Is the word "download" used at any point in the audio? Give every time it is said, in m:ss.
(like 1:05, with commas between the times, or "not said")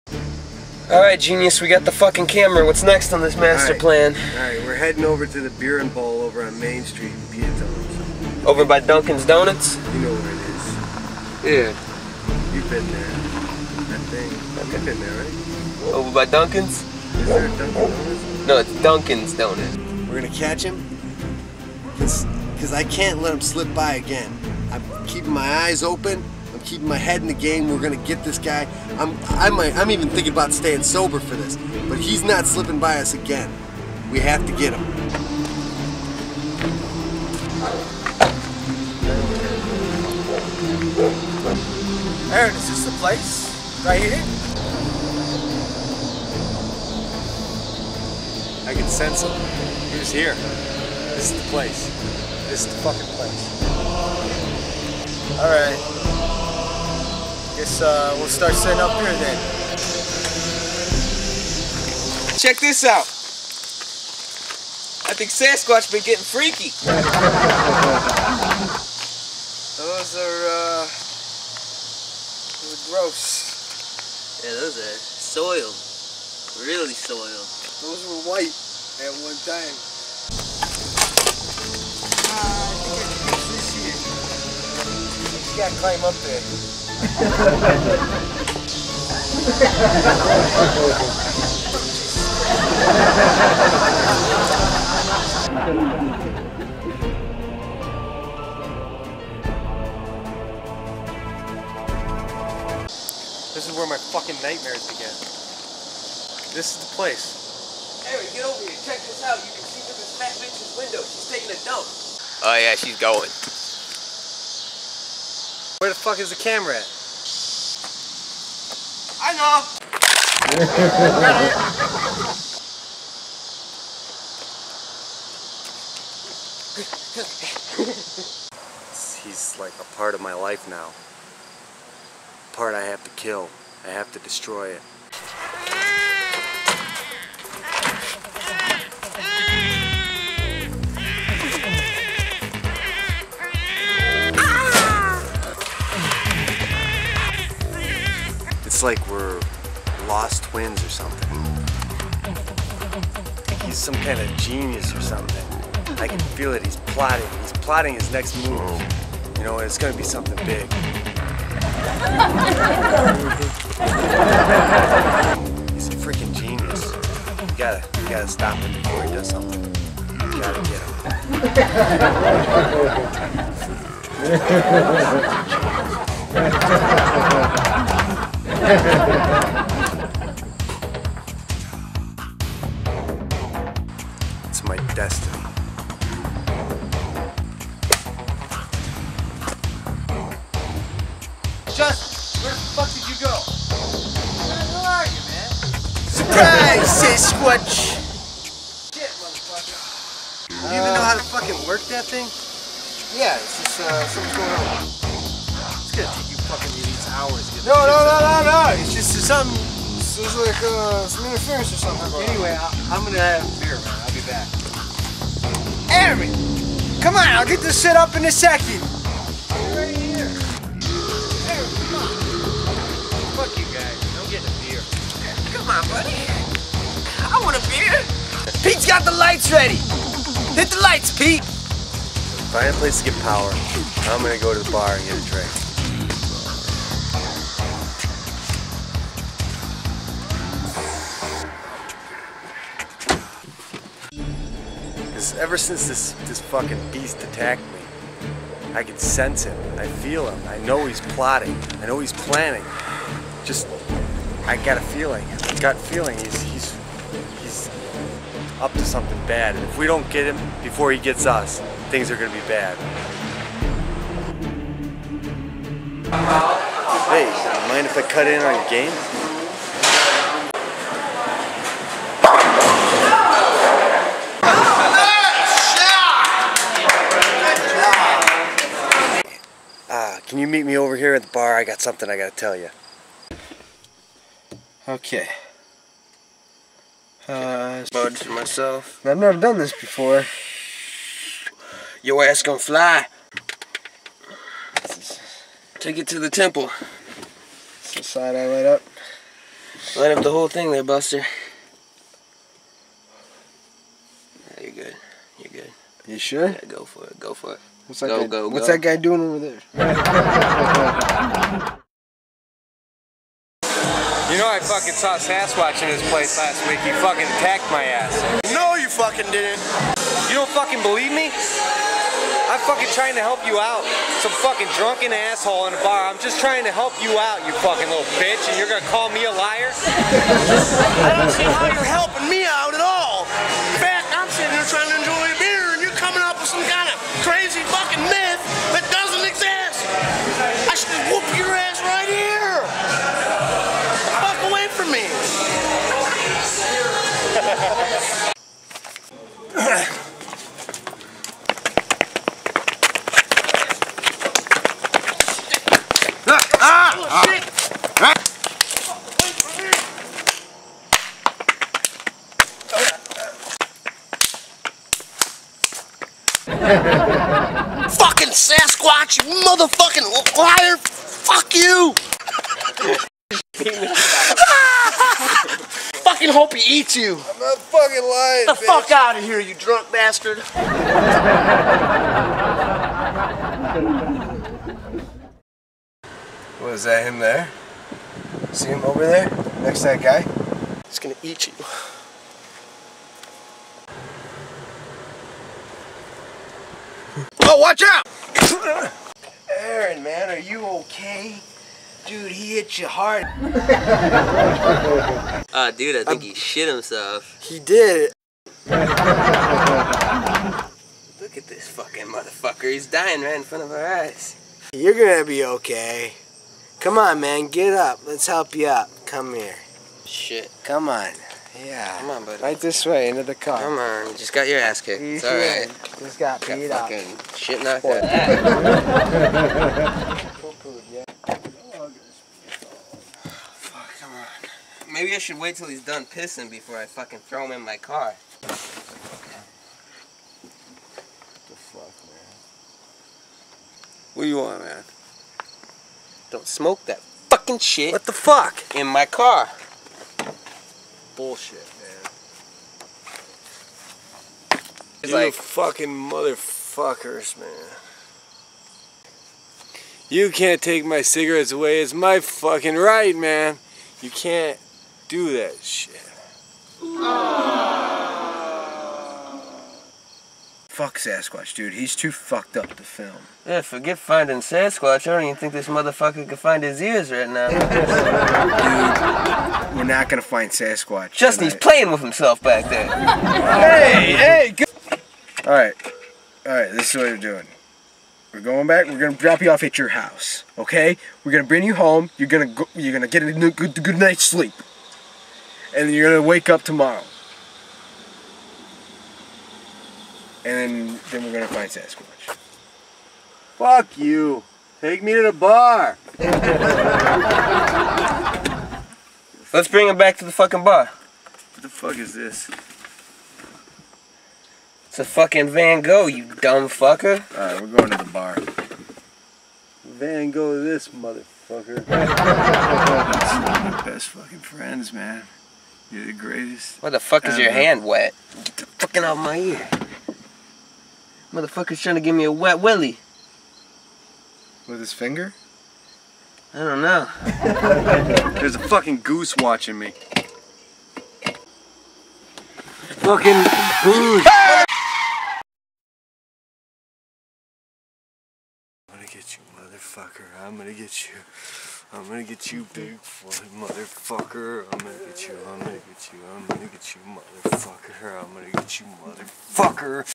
not said.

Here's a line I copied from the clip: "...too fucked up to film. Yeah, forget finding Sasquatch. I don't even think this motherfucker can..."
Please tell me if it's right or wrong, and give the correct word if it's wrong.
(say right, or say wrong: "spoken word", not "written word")
right.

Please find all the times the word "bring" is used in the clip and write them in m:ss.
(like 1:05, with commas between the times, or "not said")
8:11, 8:29.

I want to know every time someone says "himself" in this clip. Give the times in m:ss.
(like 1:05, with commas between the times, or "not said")
6:46, 8:02.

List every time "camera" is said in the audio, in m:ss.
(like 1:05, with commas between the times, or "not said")
0:02, 1:56.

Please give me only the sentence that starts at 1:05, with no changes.
I think Sasquatch been getting freaky.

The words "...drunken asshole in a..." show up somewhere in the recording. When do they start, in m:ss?
5:24.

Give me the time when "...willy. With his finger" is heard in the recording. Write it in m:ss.
8:52.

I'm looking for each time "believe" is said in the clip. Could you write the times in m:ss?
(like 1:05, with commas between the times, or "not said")
5:20.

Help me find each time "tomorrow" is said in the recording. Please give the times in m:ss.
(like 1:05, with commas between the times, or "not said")
8:16.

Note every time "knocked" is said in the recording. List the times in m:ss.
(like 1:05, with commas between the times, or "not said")
7:07.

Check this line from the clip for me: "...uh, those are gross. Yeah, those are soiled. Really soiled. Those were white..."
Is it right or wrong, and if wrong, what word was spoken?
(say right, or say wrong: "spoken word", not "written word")
right.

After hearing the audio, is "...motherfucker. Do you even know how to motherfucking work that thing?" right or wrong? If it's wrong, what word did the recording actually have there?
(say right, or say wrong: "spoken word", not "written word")
wrong: "fucking", not "motherfucking".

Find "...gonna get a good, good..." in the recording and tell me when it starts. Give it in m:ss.
8:12.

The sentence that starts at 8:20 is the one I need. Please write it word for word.
And then, then we're gonna find Sasquatch.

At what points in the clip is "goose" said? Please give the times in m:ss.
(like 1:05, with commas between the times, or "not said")
8:58, 9:03.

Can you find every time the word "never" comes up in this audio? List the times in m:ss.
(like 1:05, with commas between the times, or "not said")
4:49.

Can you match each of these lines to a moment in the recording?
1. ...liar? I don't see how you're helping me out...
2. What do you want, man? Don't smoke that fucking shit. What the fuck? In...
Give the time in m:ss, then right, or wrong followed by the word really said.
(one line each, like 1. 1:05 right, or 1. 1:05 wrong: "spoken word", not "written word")
1. 5:29 right
2. 7:24 right.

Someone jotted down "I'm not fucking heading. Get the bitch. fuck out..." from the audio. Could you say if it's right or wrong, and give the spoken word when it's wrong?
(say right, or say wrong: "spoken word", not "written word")
wrong: "lying", not "heading".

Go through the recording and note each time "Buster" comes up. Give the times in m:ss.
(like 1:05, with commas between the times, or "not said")
5:00.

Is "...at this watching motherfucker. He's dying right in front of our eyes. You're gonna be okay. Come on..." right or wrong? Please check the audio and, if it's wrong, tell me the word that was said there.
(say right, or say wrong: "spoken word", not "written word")
wrong: "fucking", not "watching".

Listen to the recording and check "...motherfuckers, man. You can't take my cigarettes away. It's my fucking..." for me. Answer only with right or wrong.
right.